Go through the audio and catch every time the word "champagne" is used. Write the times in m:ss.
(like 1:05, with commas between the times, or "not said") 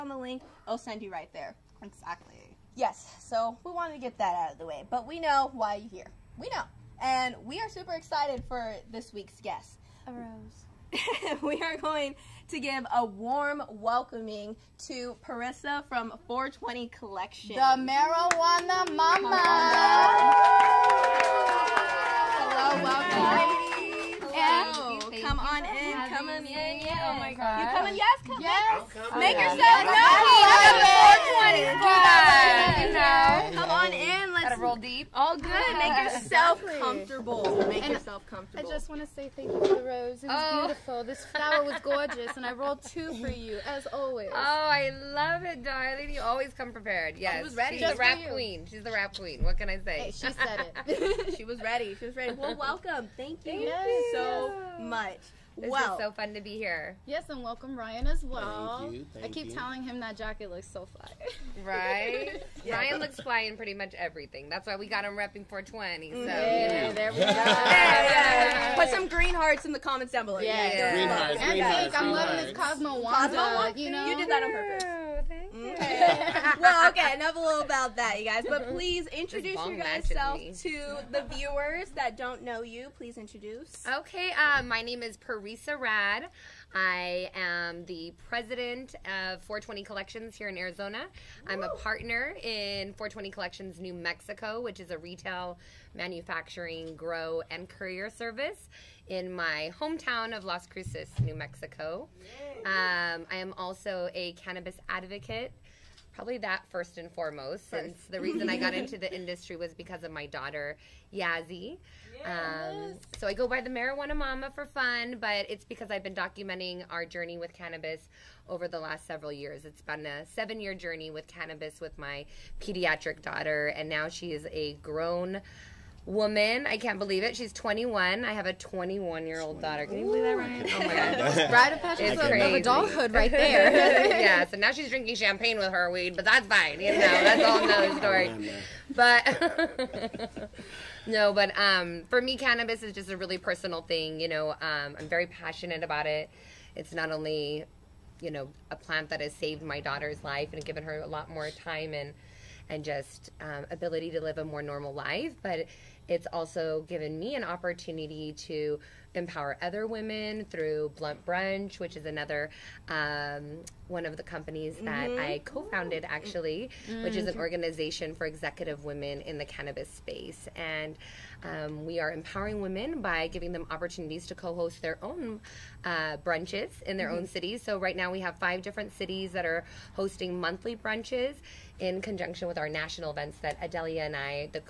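2:15.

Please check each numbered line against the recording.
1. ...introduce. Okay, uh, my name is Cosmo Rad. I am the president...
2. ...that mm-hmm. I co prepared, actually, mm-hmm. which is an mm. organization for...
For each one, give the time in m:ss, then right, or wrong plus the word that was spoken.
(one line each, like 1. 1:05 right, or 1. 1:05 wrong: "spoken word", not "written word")
1. 1:23 wrong: "Parisa", not "Cosmo"
2. 2:44 wrong: "founded", not "prepared".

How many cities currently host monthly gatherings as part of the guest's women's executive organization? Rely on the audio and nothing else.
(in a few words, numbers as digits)
5.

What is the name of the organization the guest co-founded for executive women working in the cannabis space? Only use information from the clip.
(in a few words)
Blunt Brunch.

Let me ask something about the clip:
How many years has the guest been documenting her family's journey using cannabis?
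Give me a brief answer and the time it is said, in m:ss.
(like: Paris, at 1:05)
7, at 2:00.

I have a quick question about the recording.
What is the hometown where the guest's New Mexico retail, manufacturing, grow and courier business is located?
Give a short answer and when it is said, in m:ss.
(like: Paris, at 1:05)
Las Cruces, at 1:40.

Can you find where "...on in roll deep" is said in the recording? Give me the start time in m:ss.
0:33.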